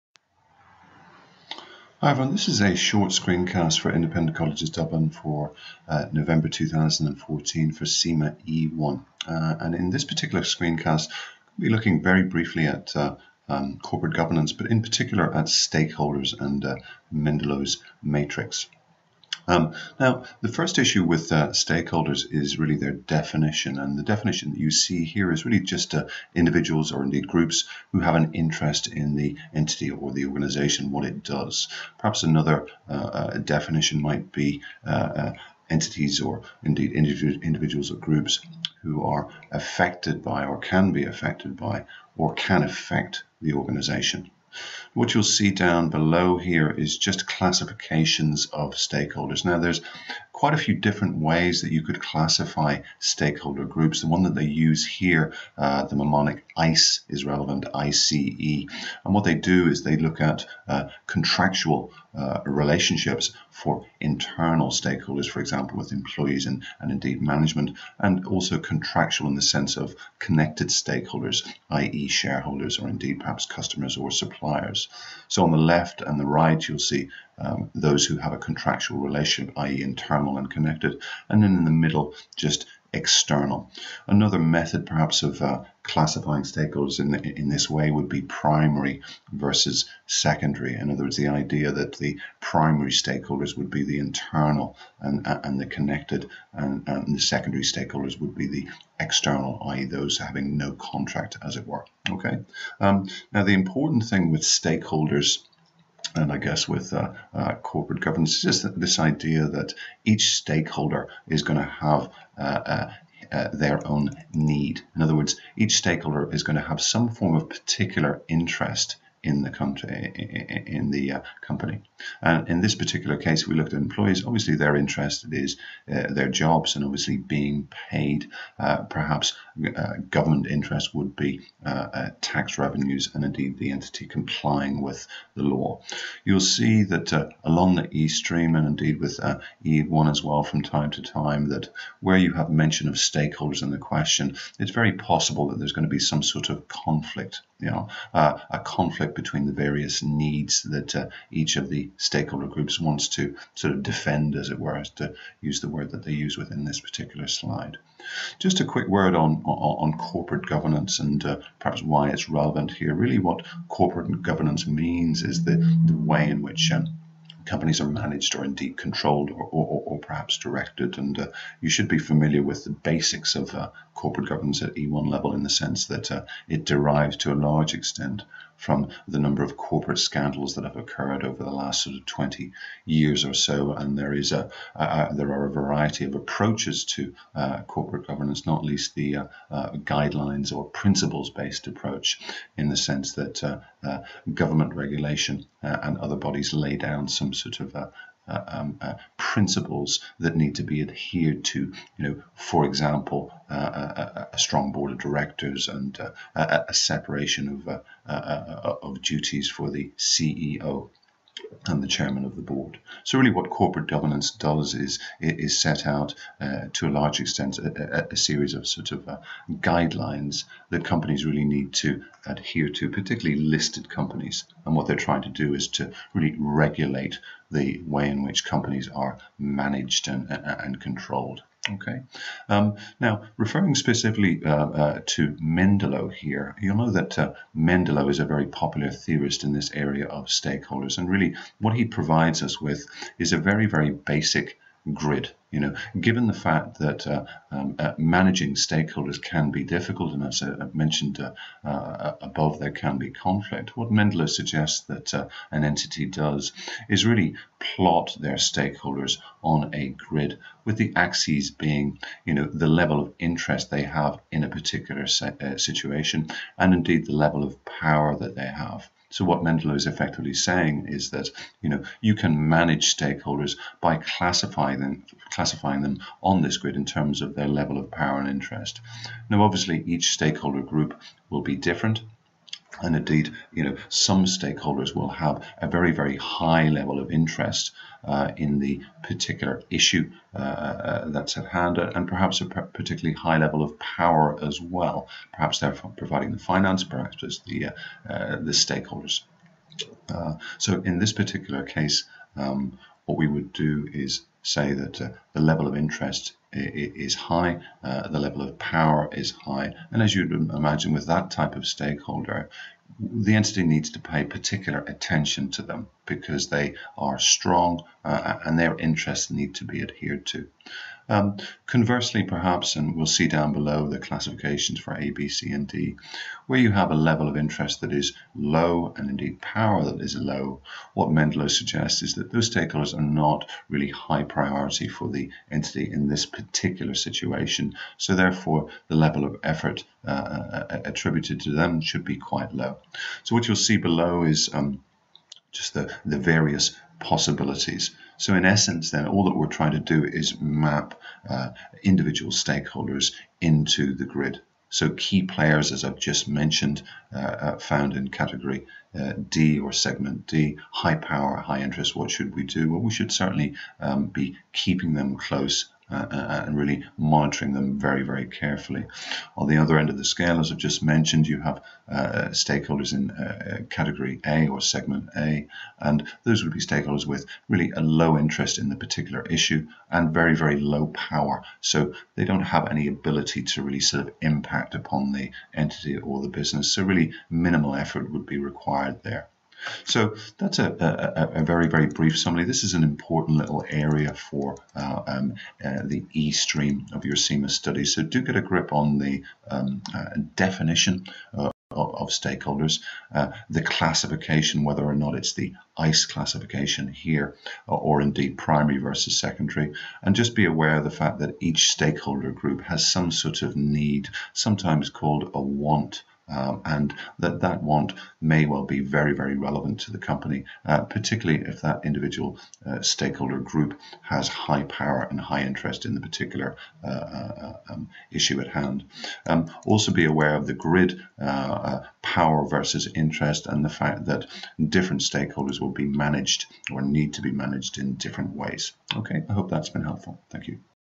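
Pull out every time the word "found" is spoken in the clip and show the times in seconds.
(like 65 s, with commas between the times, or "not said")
357 s.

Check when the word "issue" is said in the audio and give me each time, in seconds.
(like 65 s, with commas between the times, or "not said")
20 s, 289 s, 379 s, 428 s.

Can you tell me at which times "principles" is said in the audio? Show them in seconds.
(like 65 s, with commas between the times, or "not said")
190 s, 199 s.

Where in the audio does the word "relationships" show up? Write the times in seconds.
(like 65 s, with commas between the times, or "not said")
62 s, 78 s.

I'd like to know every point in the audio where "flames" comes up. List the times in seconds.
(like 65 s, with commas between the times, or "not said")
not said.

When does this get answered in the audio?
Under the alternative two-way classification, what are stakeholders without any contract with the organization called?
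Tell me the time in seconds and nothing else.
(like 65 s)
97 s.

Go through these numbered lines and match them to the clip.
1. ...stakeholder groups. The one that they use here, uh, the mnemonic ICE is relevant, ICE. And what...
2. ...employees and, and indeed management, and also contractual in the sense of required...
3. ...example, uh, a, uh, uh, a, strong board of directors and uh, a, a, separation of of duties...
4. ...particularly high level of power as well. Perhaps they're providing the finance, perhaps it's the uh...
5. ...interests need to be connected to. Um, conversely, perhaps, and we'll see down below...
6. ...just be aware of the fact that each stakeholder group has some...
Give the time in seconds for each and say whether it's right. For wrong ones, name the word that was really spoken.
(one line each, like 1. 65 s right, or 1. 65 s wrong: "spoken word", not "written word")
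1. 52 s right
2. 65 s wrong: "connected", not "required"
3. 202 s right
4. 292 s right
5. 318 s wrong: "adhered", not "connected"
6. 410 s right.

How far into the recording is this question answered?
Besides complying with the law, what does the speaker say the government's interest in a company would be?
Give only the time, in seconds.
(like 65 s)
132 s.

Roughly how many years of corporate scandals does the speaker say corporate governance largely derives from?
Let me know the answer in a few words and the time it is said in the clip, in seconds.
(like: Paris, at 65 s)
20 years, at 182 s.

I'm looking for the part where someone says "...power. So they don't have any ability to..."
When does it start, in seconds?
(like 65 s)
380 s.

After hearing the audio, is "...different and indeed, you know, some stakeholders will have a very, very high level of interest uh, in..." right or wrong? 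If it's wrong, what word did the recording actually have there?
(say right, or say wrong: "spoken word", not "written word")
right.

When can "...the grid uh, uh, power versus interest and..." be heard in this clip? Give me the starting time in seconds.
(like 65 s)
430 s.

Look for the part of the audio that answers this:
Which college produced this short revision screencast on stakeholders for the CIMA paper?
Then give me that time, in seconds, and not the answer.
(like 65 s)
3 s.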